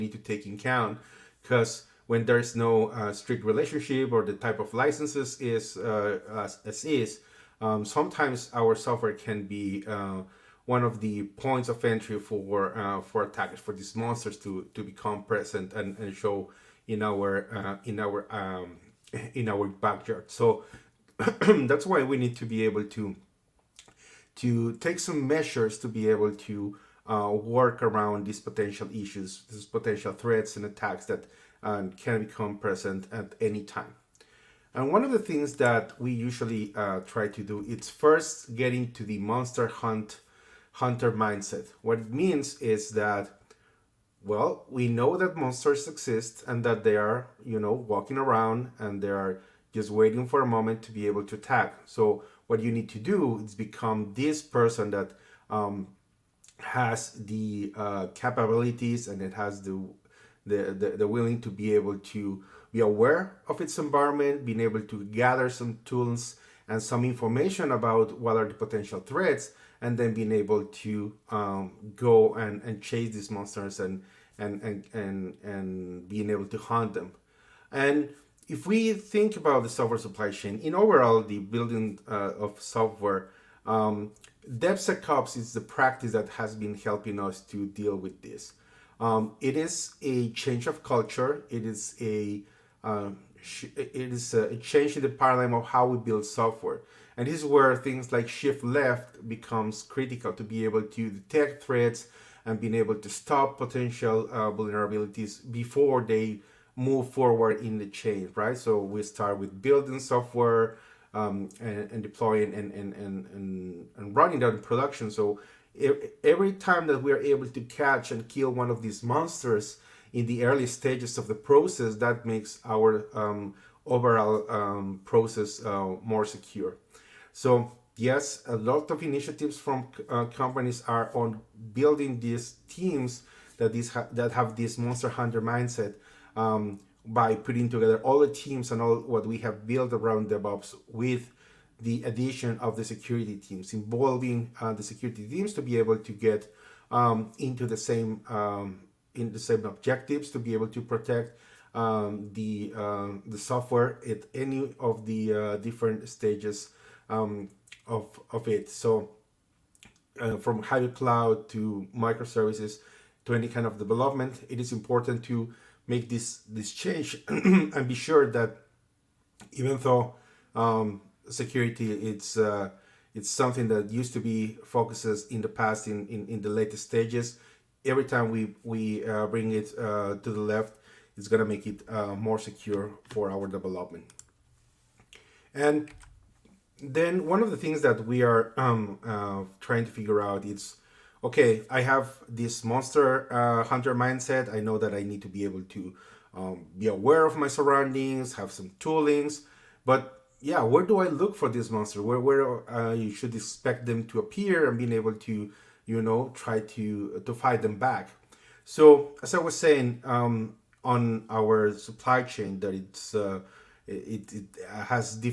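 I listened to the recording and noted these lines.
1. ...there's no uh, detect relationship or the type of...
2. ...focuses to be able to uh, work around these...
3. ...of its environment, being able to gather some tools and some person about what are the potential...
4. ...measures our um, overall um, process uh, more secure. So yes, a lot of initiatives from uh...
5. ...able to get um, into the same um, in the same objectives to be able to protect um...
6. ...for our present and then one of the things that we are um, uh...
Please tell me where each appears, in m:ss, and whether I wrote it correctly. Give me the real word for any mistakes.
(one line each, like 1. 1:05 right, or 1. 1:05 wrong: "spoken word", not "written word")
1. 0:02 wrong: "strict", not "detect"
2. 0:25 wrong: "measures", not "focuses"
3. 1:03 wrong: "information", not "person"
4. 2:02 wrong: "makes", not "measures"
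5. 2:25 right
6. 3:03 wrong: "development", not "present".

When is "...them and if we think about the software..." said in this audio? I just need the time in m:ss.
1:16.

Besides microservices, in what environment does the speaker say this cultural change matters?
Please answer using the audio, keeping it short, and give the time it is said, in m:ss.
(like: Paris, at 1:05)
Hybrid cloud, at 2:40.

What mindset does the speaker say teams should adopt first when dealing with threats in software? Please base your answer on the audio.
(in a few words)
Monster hunter mindset.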